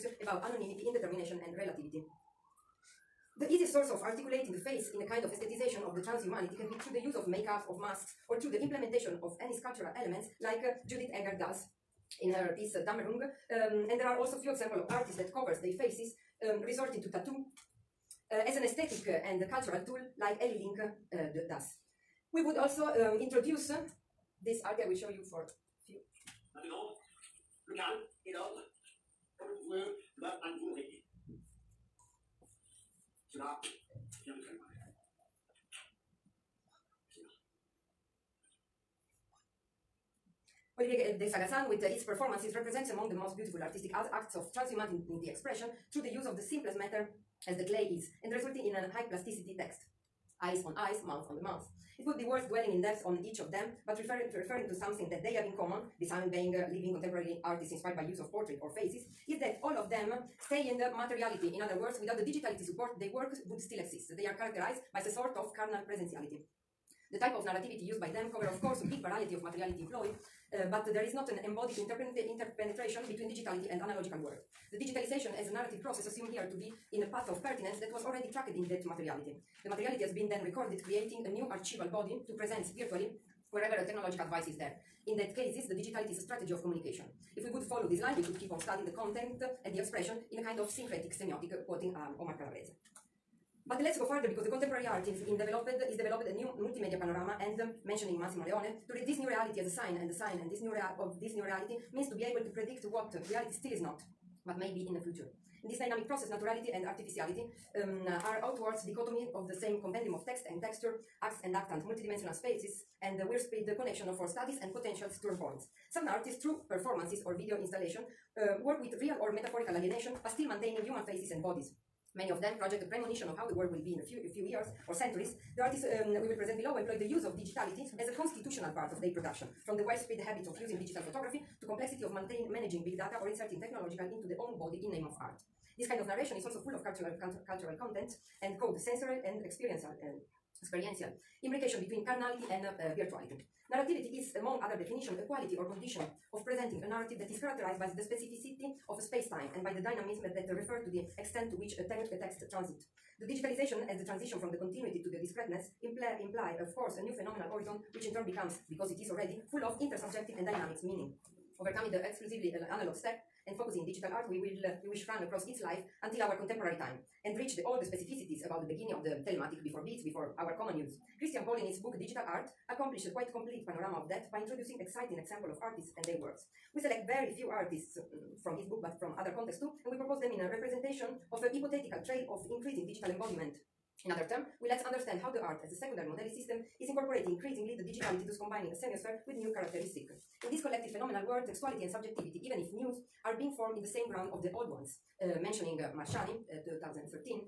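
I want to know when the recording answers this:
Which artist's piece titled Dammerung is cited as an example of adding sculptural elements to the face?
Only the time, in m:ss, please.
0:10.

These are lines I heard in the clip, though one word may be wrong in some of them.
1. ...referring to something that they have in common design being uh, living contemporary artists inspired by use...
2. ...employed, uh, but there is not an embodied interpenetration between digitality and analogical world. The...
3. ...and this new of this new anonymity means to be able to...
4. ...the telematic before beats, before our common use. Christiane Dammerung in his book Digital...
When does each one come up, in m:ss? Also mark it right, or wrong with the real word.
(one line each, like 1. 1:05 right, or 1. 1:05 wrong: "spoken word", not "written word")
1. 0:54 right
2. 1:09 right
3. 1:40 wrong: "reality", not "anonymity"
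4. 2:49 wrong: "Paul", not "Dammerung".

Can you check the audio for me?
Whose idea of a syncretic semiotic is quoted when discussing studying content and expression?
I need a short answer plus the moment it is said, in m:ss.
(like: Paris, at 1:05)
Omar Calabrese, at 1:32.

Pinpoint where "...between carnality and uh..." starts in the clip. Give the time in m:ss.
2:21.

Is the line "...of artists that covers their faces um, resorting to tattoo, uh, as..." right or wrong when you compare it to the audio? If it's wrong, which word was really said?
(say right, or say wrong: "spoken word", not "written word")
right.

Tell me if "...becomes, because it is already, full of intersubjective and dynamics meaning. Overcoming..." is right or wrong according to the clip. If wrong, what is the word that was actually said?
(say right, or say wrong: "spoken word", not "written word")
right.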